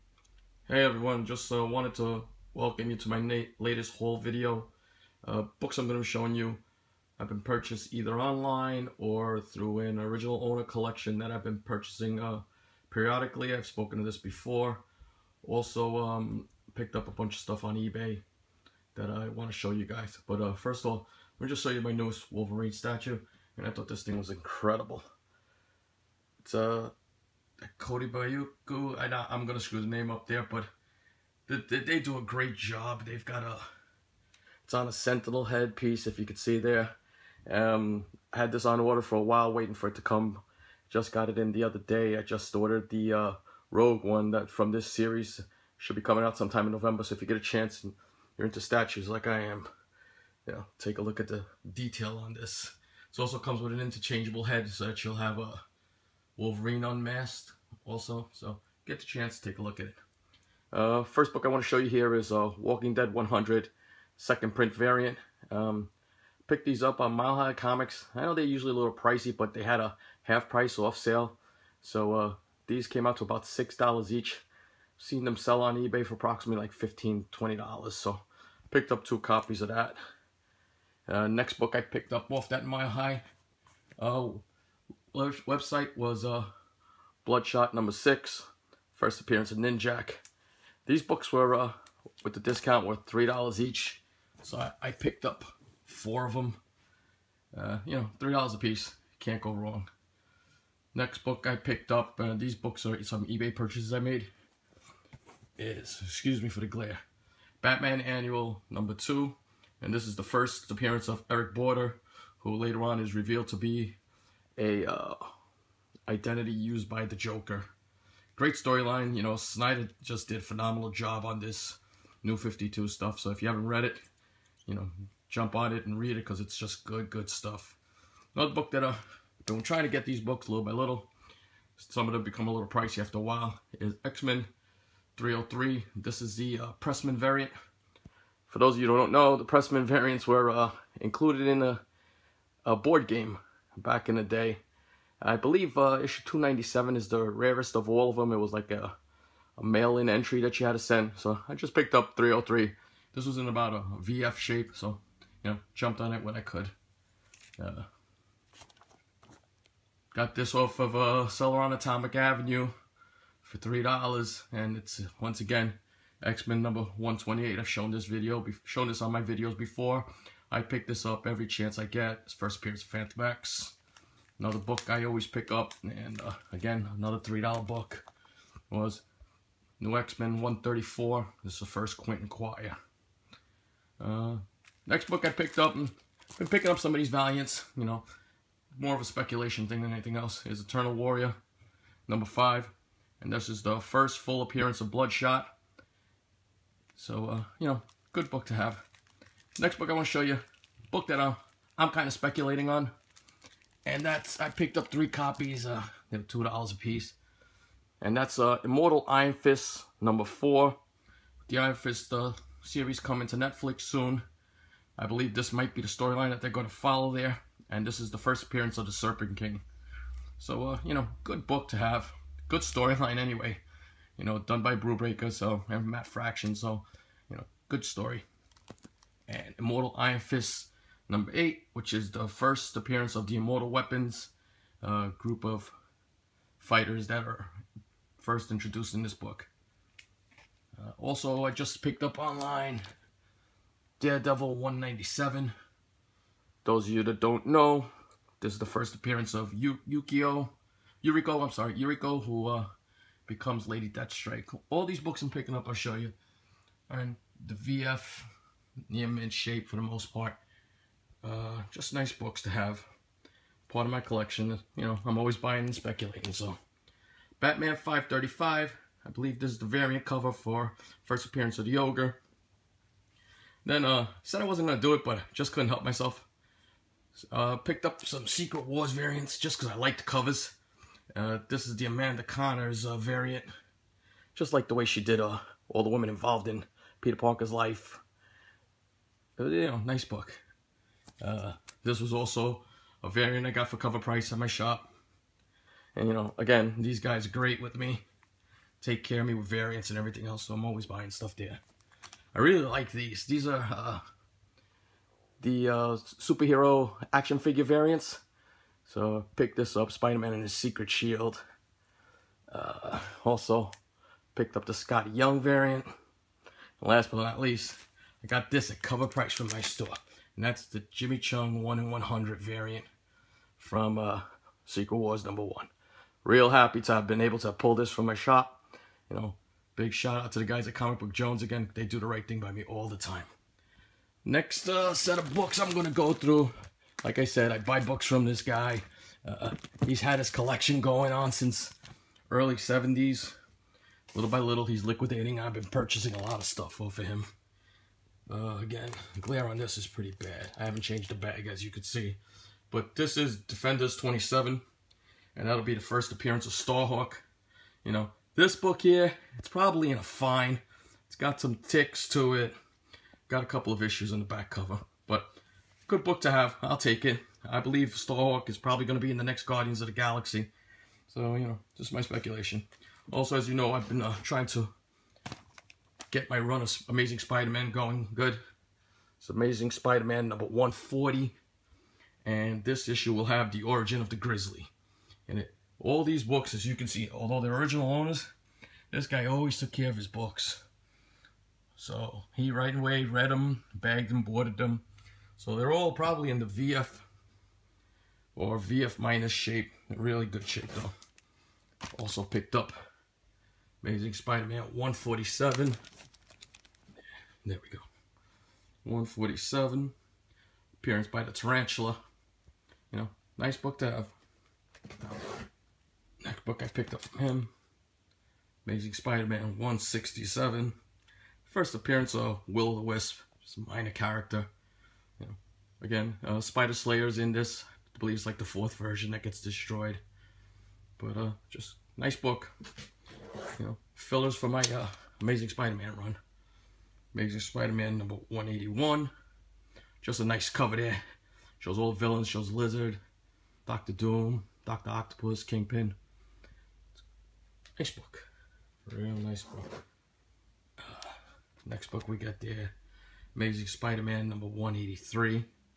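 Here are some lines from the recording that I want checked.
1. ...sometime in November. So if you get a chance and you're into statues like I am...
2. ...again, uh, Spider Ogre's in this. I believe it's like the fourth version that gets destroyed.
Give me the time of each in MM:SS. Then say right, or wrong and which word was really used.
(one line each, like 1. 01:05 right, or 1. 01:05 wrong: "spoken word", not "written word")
1. 00:46 right
2. 07:05 wrong: "Slayer", not "Ogre".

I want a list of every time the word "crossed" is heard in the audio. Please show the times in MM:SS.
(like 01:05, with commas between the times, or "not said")
not said.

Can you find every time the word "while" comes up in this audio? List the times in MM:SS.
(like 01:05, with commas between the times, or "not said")
00:39, 02:13.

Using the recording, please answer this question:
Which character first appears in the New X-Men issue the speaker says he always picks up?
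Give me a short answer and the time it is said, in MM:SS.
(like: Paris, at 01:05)
Quentin Quire, at 03:01.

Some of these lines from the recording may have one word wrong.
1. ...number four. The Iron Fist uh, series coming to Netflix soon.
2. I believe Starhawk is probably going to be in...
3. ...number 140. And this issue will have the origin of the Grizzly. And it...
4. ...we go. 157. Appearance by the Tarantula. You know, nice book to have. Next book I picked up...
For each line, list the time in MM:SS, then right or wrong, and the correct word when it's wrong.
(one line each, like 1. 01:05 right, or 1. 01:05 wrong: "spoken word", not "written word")
1. 03:30 right
2. 06:07 right
3. 06:20 right
4. 06:47 wrong: "147", not "157".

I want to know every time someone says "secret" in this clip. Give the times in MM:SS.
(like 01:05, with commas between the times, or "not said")
04:38, 05:10, 05:24.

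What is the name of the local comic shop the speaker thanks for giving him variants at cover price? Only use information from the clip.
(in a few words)
Comic Book Jones.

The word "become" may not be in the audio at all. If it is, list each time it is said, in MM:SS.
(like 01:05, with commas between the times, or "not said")
02:12, 04:13.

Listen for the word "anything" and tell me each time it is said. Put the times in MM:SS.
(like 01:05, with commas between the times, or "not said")
03:09.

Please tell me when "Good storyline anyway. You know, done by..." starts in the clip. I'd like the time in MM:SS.
03:42.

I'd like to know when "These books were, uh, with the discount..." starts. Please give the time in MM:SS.
01:30.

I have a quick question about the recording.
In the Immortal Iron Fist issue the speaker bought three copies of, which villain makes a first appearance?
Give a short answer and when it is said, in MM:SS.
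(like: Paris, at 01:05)
the Serpent King, at 03:38.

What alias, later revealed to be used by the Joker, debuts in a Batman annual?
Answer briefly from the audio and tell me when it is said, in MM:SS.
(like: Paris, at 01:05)
Eric Border, at 01:51.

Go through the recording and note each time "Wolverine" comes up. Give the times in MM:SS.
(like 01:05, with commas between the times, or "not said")
00:22, 00:56.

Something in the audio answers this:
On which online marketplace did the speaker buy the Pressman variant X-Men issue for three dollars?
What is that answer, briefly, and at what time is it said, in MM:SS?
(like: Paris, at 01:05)
Atomic Avenue, at 02:41.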